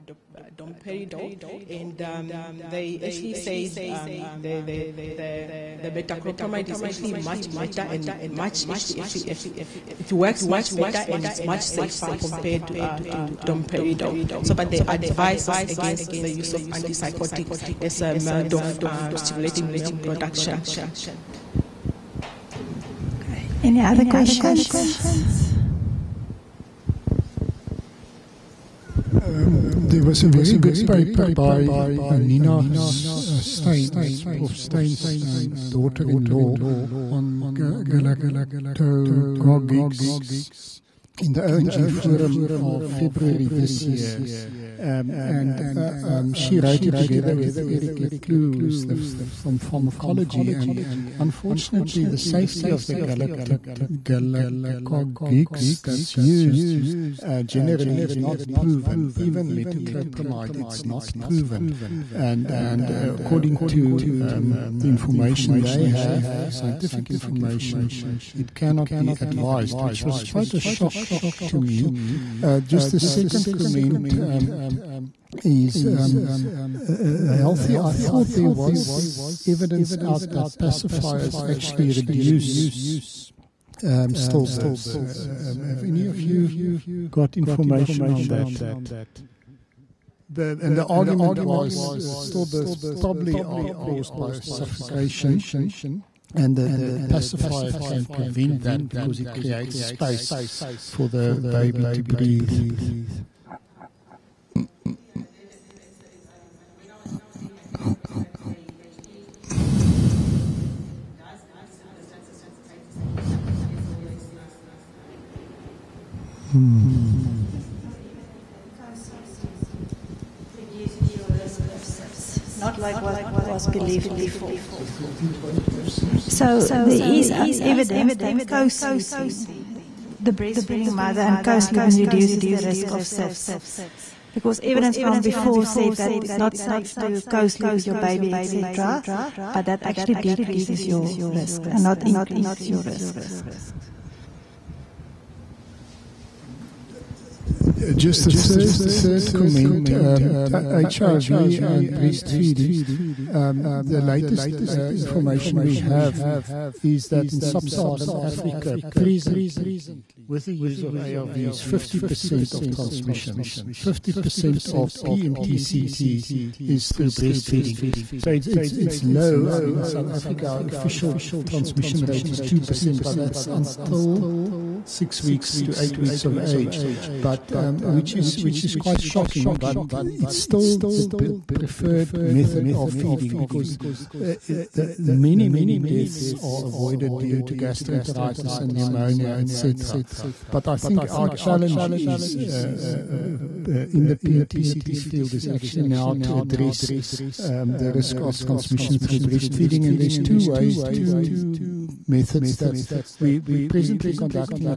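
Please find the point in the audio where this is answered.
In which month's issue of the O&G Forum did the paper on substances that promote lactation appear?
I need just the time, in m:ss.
0:42.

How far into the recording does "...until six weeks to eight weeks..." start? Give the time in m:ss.
2:53.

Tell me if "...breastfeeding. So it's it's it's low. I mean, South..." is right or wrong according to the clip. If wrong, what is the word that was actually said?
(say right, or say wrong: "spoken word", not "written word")
right.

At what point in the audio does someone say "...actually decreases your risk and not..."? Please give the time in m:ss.
2:19.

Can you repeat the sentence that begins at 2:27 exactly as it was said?
just a third third comment: um, HIV and breastfeeding.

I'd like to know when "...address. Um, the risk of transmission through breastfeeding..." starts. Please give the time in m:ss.
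3:16.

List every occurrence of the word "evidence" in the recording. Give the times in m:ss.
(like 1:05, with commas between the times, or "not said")
1:19, 2:07, 2:14.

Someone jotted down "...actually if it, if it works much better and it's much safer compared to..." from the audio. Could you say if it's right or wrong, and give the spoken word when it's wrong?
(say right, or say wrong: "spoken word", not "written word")
right.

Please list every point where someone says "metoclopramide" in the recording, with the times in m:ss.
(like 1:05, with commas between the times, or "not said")
0:06, 0:59.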